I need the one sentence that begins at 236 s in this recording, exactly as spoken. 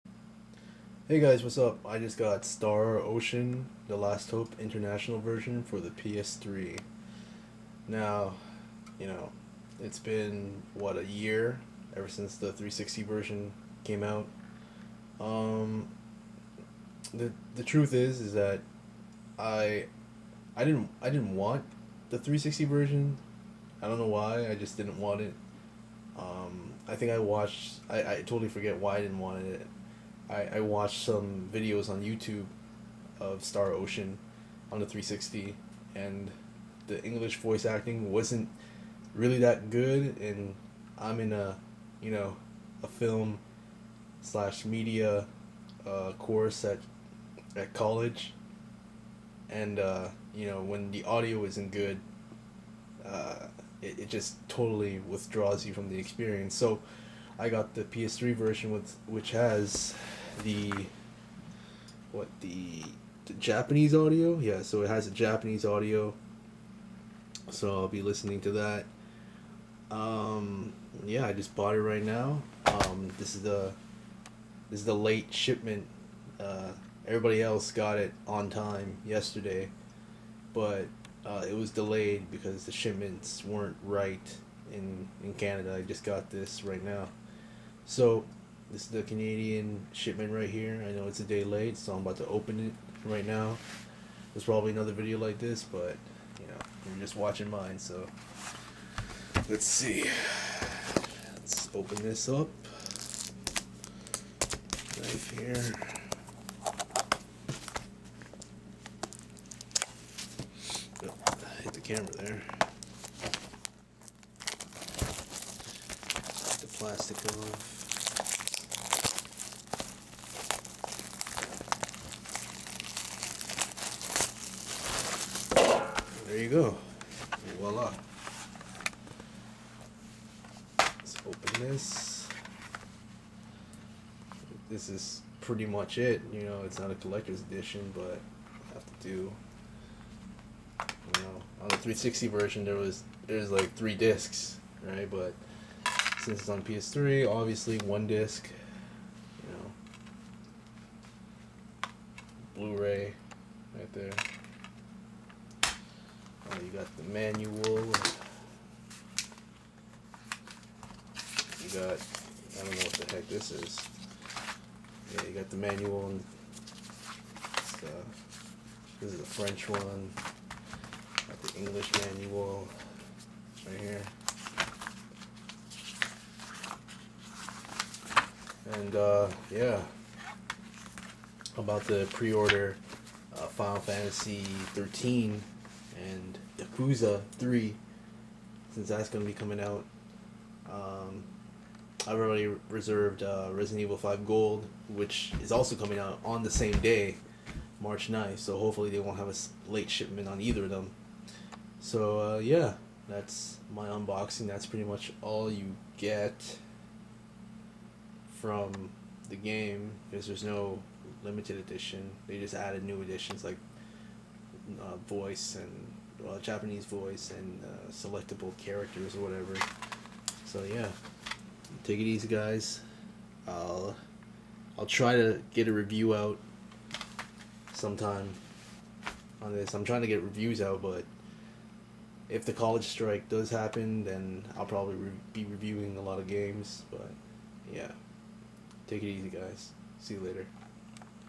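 But yeah, take it easy, guys.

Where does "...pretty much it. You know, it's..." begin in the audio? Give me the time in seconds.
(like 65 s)
135 s.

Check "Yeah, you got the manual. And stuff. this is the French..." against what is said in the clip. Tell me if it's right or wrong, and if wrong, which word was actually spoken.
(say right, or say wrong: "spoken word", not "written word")
right.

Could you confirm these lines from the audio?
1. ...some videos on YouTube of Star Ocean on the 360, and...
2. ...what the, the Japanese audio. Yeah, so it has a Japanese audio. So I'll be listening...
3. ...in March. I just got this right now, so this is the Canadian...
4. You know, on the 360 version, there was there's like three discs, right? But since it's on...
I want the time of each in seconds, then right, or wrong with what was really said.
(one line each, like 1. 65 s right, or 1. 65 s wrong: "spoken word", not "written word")
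1. 31 s right
2. 62 s right
3. 85 s wrong: "Canada", not "March"
4. 140 s right.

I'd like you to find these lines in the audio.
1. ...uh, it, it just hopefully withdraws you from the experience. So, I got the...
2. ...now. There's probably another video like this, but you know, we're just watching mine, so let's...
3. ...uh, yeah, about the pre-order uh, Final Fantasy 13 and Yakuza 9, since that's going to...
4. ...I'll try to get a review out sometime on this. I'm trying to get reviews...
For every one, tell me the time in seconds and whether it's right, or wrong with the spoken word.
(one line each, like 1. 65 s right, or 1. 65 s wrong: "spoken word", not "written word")
1. 53 s wrong: "totally", not "hopefully"
2. 93 s right
3. 178 s wrong: "3", not "9"
4. 224 s right.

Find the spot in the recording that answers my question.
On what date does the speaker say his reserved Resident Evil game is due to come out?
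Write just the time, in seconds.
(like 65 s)
197 s.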